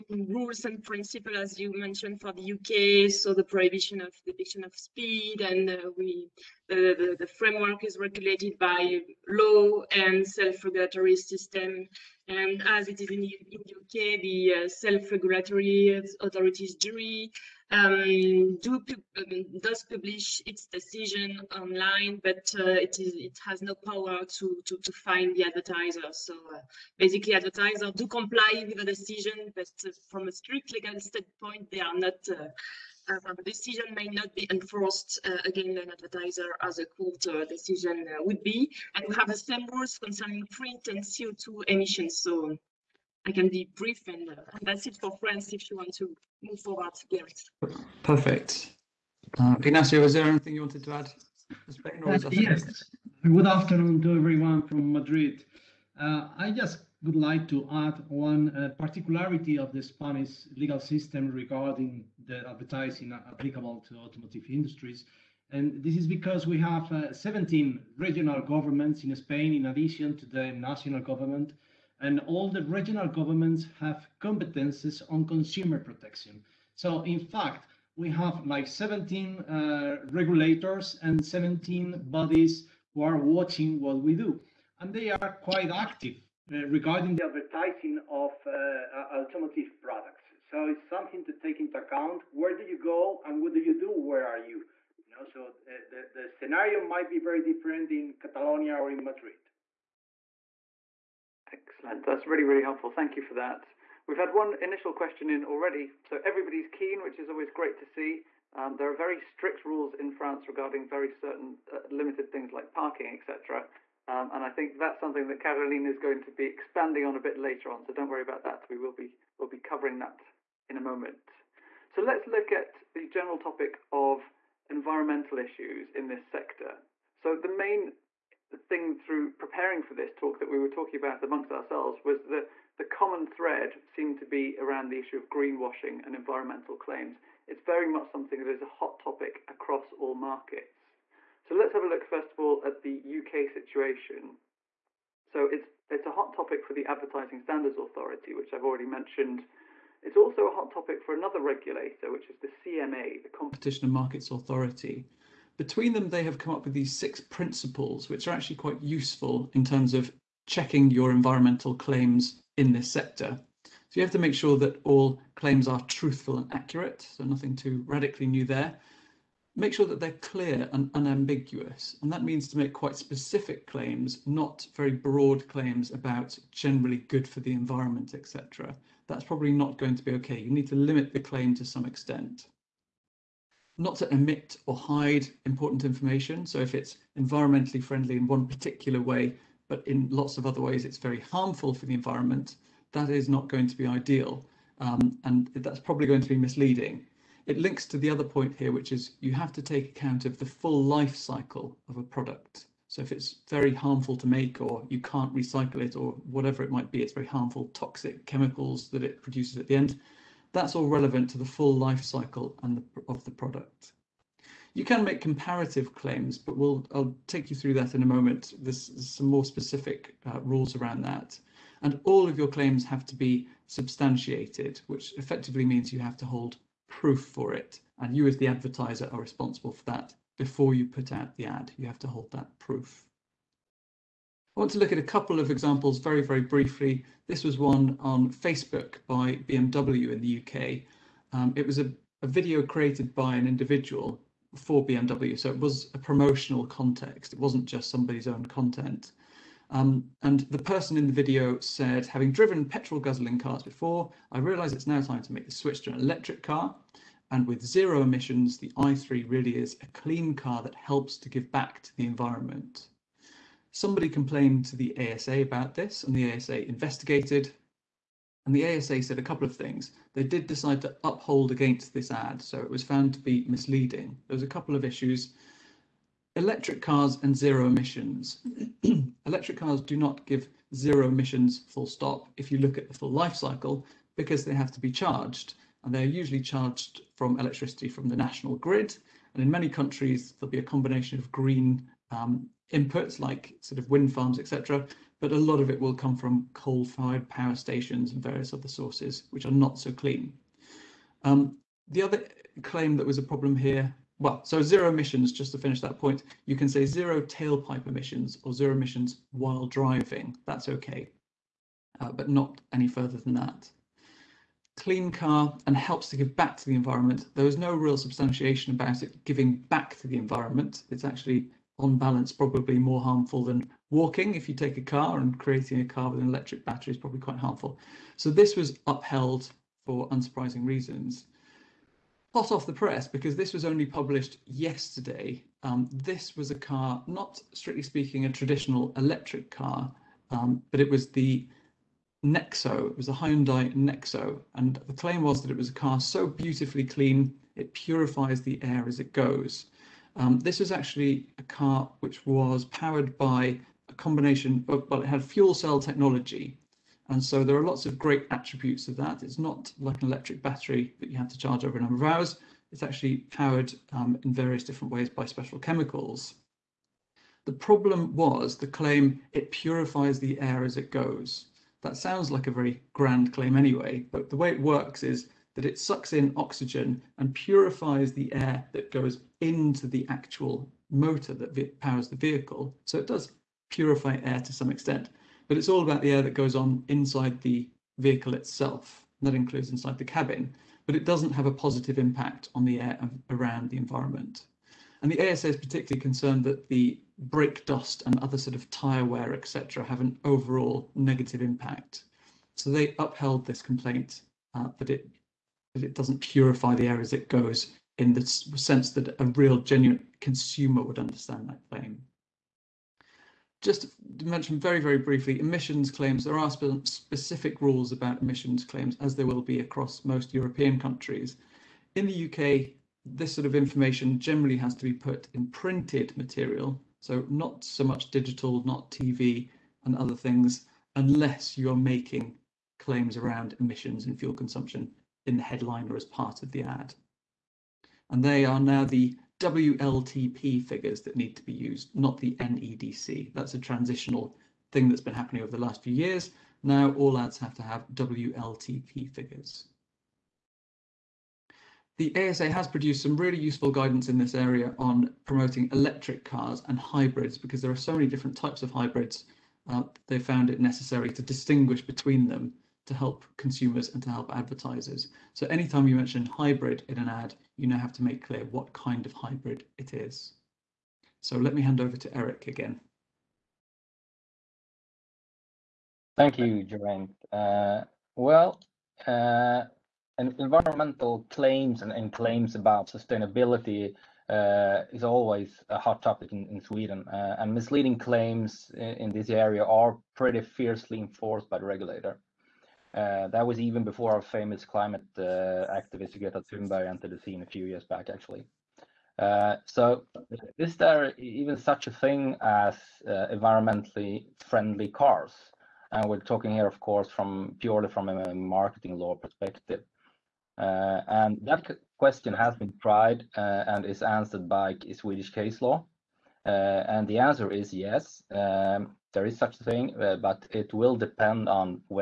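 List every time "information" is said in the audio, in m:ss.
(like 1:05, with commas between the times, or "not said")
3:05, 7:03.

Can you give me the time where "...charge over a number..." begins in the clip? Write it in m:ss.
6:01.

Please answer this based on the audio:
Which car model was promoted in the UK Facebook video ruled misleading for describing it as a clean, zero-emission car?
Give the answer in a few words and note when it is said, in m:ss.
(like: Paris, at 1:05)
i3, at 4:18.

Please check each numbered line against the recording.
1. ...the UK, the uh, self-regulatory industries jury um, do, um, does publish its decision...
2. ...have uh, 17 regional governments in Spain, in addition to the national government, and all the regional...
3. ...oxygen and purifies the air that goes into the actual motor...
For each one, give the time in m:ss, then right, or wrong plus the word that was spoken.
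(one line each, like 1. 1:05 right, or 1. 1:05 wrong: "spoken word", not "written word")
1. 0:13 wrong: "authorities", not "industries"
2. 1:06 right
3. 6:16 right.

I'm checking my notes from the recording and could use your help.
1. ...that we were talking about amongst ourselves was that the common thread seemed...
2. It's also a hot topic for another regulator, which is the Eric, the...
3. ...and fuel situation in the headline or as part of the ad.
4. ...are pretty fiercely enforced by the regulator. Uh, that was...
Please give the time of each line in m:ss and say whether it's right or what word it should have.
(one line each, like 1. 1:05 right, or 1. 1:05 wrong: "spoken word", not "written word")
1. 2:10 right
2. 2:30 wrong: "CMA", not "Eric"
3. 7:14 wrong: "consumption", not "situation"
4. 8:09 right.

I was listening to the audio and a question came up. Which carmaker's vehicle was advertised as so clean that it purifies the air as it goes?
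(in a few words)
Hyundai.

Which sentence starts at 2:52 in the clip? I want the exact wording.
And that means to make quite specific claims, not very broad claims about generally good for the environment, etc.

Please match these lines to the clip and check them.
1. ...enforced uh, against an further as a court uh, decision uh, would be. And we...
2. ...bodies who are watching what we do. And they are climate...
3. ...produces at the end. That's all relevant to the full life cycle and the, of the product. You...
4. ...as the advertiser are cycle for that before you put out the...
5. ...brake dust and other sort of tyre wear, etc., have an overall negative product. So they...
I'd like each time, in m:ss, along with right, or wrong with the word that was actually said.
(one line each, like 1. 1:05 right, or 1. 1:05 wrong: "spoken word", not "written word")
1. 0:34 wrong: "advertiser", not "further"
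2. 1:22 wrong: "quite", not "climate"
3. 3:29 right
4. 3:48 wrong: "responsible", not "cycle"
5. 6:37 wrong: "impact", not "product".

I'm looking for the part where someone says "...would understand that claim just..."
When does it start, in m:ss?
6:50.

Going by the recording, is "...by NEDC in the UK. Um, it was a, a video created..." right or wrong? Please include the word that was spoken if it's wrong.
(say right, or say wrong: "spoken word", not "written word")
wrong: "BMW", not "NEDC".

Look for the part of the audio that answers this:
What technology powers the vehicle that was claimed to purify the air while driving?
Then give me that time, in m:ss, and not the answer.
5:55.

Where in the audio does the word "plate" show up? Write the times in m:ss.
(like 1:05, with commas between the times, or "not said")
not said.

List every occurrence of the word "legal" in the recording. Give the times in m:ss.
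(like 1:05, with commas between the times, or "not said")
0:30, 1:00.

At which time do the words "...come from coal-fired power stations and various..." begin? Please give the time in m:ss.
4:55.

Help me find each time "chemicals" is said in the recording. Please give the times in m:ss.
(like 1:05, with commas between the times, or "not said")
3:28, 6:05.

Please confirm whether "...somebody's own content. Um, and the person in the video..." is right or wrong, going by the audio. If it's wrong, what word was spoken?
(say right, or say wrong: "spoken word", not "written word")
right.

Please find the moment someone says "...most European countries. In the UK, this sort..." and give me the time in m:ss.
7:00.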